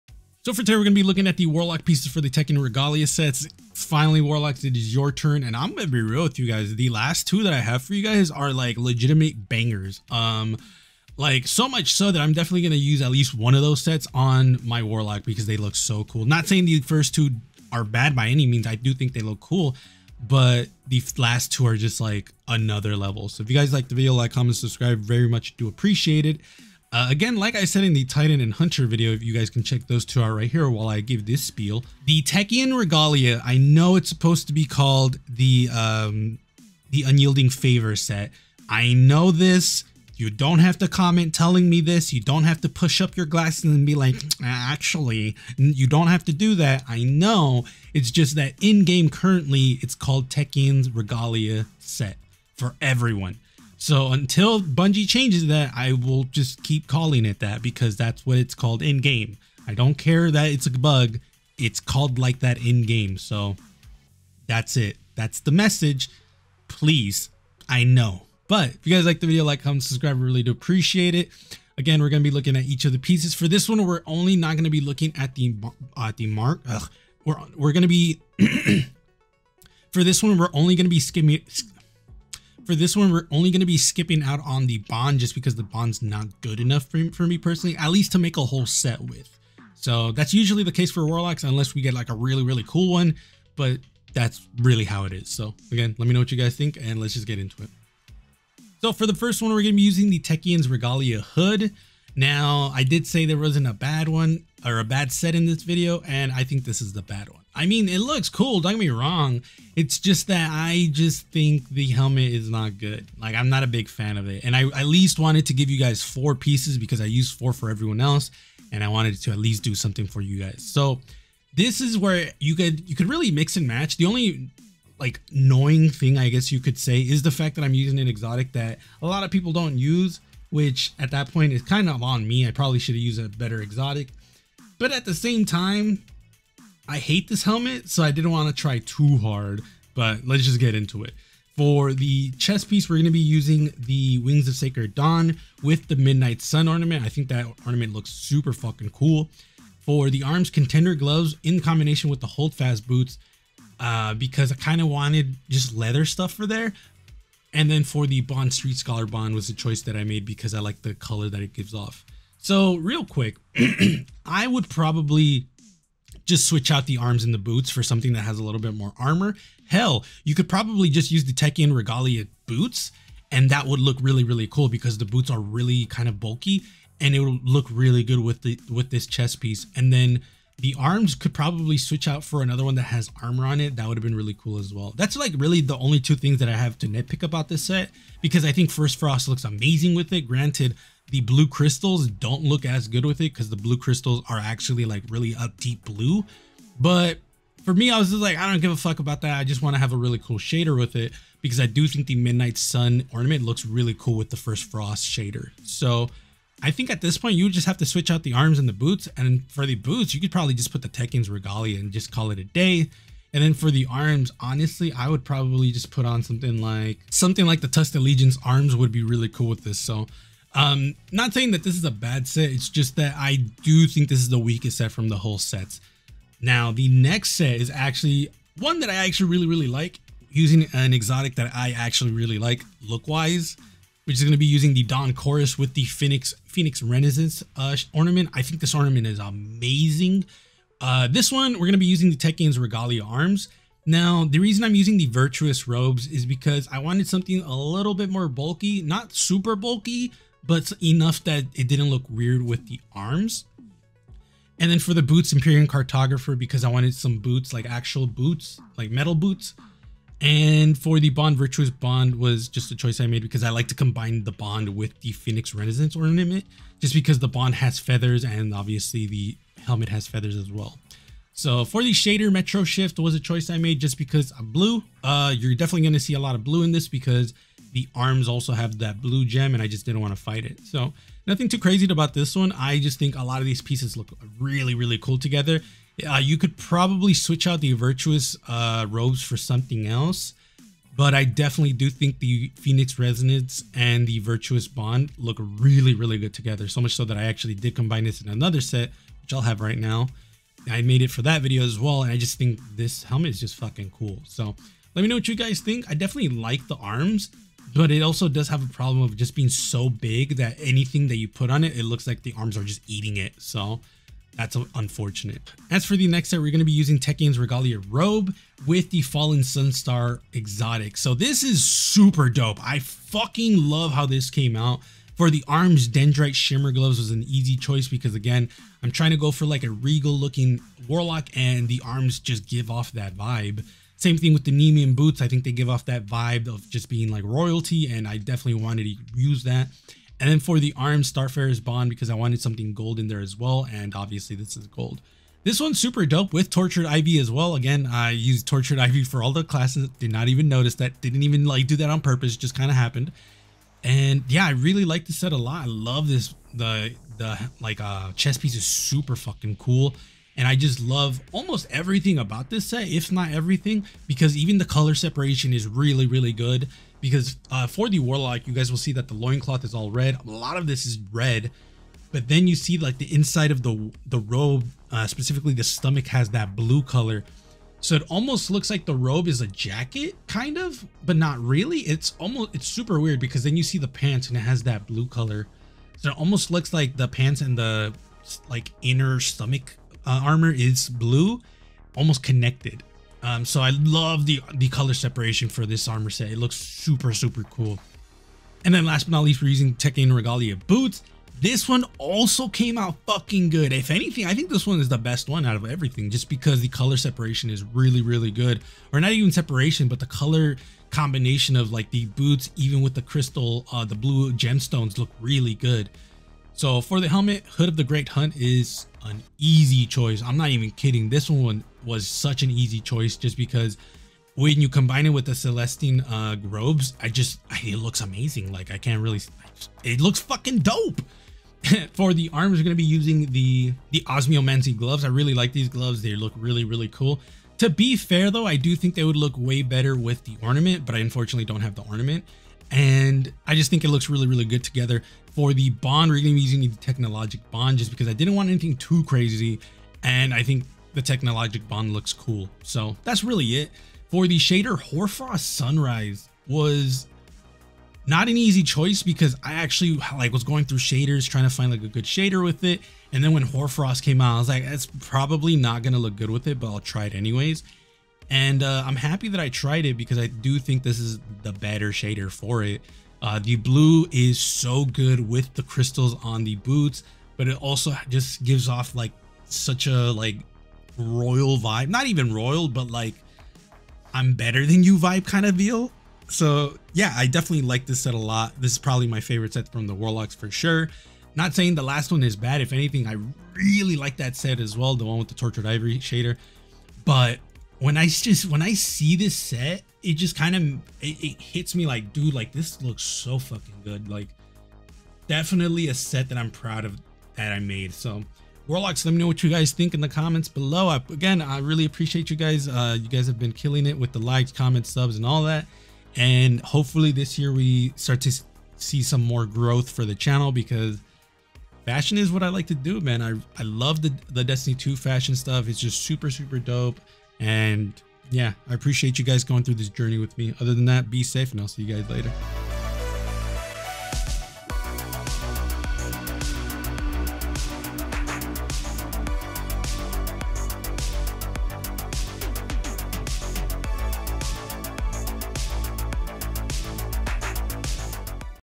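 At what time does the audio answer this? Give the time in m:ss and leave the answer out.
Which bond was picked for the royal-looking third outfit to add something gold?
5:41.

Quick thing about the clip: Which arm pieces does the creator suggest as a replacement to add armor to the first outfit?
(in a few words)
Tusk Allegiance arms.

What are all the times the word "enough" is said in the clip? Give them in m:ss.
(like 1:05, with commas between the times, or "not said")
1:26, 4:10.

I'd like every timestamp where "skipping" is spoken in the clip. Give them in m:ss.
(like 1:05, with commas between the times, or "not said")
1:23.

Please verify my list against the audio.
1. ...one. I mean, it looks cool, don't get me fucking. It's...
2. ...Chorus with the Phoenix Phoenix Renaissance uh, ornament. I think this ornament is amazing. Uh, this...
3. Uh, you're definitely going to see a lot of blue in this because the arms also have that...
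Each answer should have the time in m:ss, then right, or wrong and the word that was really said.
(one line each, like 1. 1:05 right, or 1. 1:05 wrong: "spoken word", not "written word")
1. 1:47 wrong: "wrong", not "fucking"
2. 3:55 right
3. 4:35 right.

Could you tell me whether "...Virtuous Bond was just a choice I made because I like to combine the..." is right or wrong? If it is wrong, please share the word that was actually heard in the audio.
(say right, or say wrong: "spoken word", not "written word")
right.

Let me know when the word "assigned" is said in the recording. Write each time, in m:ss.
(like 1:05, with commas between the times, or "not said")
not said.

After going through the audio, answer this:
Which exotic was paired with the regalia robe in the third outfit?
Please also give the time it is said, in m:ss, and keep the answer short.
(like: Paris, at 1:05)
Fallen Sunstar, at 5:19.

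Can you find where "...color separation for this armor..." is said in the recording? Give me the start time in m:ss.
6:34.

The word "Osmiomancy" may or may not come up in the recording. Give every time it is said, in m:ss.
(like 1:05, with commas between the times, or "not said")
7:14.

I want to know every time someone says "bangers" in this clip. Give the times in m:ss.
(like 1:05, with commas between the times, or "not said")
0:09.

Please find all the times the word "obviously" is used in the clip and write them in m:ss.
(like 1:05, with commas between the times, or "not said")
4:28, 5:43.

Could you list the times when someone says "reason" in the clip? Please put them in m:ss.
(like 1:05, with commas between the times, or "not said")
4:04.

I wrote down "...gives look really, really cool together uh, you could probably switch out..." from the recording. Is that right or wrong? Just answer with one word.
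wrong.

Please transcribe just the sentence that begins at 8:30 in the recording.
I, again, I really appreciate you guys.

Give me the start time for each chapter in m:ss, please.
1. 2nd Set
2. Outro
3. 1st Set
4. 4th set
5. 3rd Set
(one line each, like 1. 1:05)
1. 3:55
2. 8:28
3. 1:38
4. 6:39
5. 5:16.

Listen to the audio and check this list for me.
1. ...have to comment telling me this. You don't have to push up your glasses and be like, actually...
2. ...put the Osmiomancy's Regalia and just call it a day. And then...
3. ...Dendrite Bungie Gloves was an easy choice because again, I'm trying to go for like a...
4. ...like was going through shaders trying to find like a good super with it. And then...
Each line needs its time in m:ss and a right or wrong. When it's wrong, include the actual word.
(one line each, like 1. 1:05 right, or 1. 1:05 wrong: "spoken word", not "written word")
1. 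0:40 right
2. 3:30 wrong: "Techeun", not "Osmiomancy"
3. 5:25 wrong: "Shimmer", not "Bungie"
4. 7:40 wrong: "shader", not "super".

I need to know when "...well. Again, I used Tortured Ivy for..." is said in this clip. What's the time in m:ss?
5:47.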